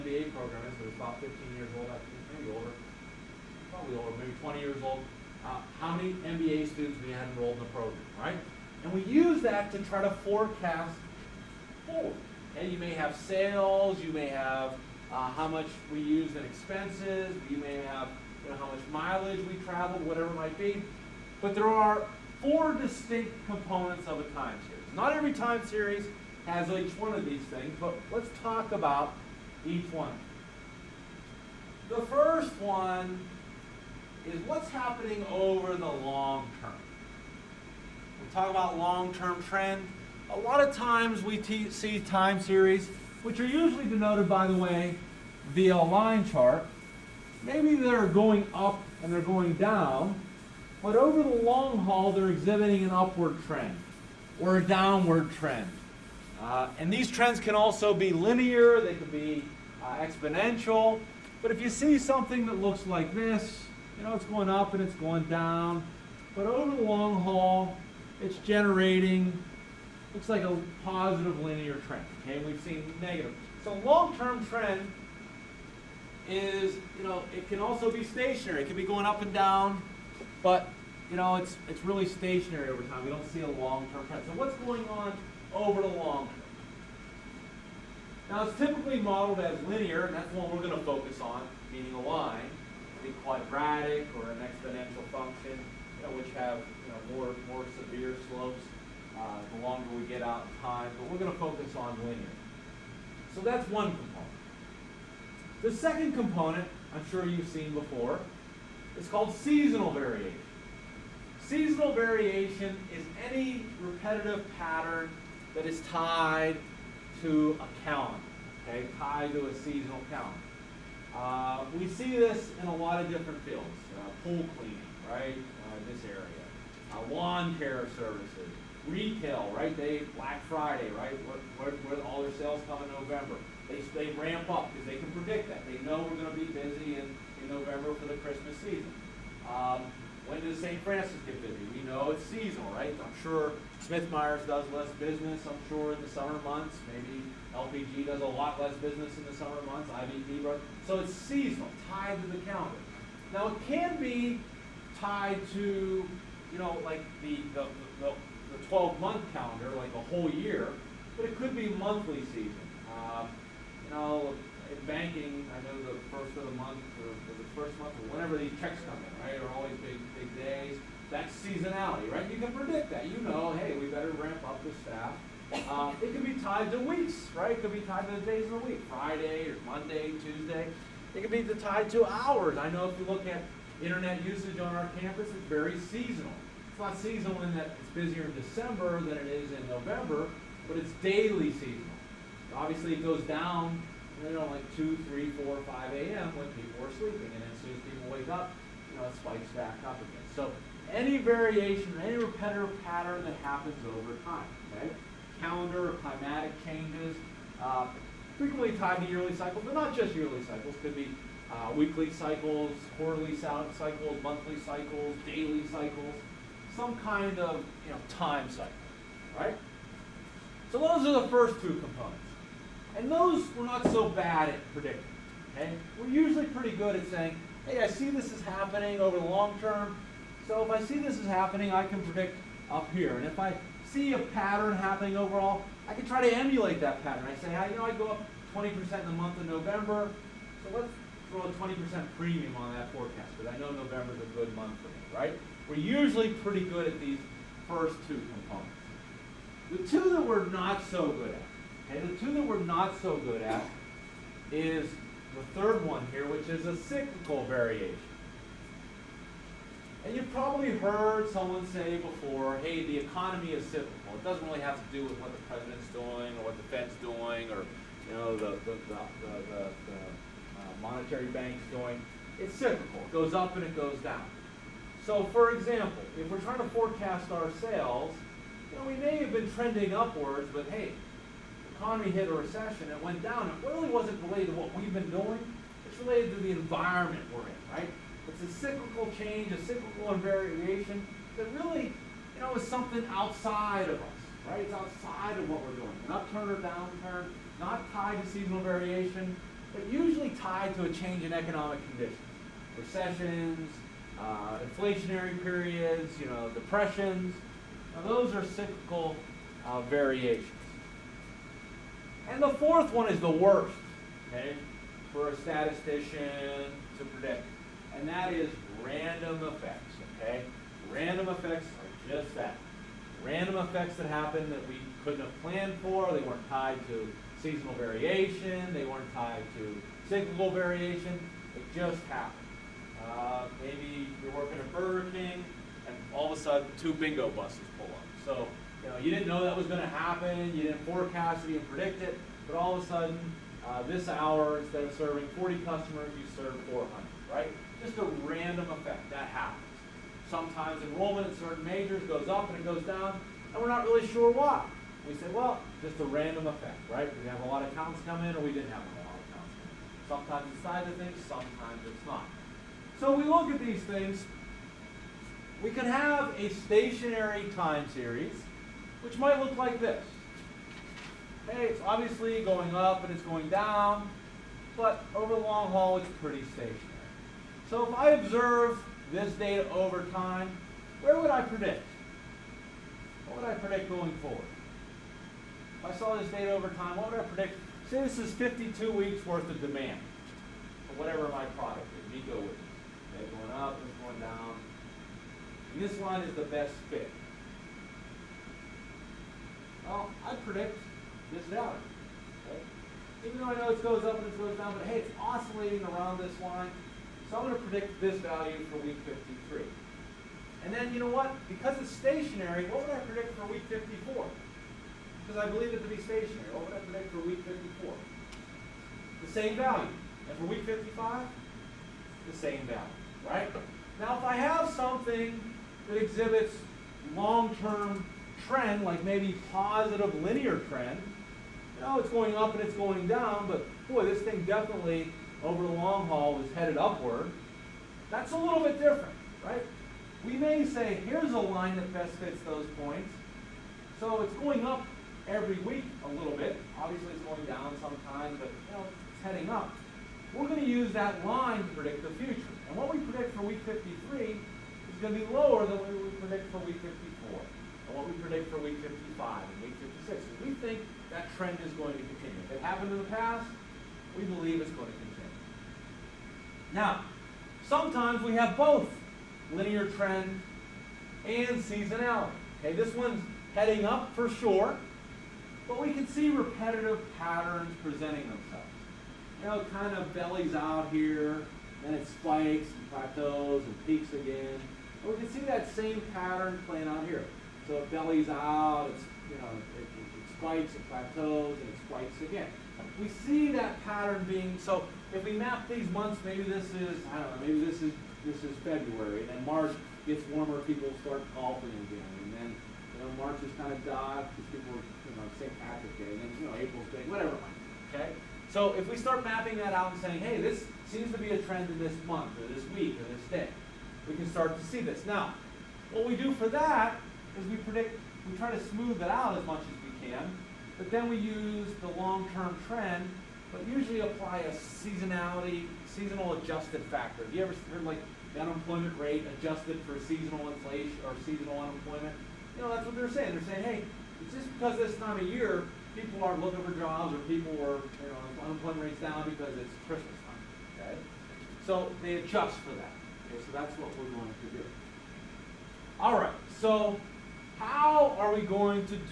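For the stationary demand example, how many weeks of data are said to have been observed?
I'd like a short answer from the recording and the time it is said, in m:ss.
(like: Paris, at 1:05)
52, at 6:28.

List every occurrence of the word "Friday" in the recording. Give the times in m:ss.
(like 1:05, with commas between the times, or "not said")
2:10, 2:58.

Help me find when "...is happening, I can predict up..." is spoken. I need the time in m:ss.
3:51.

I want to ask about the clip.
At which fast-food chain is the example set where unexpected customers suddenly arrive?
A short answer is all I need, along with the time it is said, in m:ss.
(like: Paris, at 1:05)
Burger King, at 5:34.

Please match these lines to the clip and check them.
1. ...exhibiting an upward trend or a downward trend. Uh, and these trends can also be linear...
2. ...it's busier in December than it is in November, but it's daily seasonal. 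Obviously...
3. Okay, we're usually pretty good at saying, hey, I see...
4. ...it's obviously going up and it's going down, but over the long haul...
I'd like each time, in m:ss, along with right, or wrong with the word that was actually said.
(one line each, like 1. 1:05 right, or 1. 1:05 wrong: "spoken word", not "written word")
1. 0:52 right
2. 3:07 right
3. 3:45 right
4. 6:11 right.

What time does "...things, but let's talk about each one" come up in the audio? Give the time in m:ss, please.
0:27.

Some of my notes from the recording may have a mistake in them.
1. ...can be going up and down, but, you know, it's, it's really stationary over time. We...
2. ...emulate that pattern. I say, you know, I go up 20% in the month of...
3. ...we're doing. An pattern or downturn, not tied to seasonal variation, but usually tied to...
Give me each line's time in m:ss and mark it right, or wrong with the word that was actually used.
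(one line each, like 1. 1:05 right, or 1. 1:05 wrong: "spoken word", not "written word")
1. 1:18 right
2. 3:56 right
3. 4:55 wrong: "upturn", not "pattern".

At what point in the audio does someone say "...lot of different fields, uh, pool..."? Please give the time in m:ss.
2:02.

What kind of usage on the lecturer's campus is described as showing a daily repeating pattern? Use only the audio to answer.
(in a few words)
Internet usage.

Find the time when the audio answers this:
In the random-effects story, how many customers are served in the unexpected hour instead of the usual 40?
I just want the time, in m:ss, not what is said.
5:46.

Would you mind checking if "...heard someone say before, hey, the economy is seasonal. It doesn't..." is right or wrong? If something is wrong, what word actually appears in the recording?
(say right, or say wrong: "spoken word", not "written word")
wrong: "cyclical", not "seasonal".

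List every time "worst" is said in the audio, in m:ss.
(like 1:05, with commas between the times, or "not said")
5:13.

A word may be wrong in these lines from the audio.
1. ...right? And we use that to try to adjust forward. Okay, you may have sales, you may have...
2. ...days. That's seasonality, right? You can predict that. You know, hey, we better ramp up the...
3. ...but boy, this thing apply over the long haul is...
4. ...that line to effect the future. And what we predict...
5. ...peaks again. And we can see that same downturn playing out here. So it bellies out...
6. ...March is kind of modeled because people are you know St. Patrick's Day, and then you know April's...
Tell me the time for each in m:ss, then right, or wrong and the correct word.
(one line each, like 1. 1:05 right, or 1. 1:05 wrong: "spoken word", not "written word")
1. 0:08 wrong: "forecast", not "adjust"
2. 2:50 right
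3. 7:13 wrong: "definitely", not "apply"
4. 7:30 wrong: "predict", not "effect"
5. 8:03 wrong: "pattern", not "downturn"
6. 8:23 wrong: "dodged", not "modeled".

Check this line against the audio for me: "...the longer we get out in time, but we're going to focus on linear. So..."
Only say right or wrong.
right.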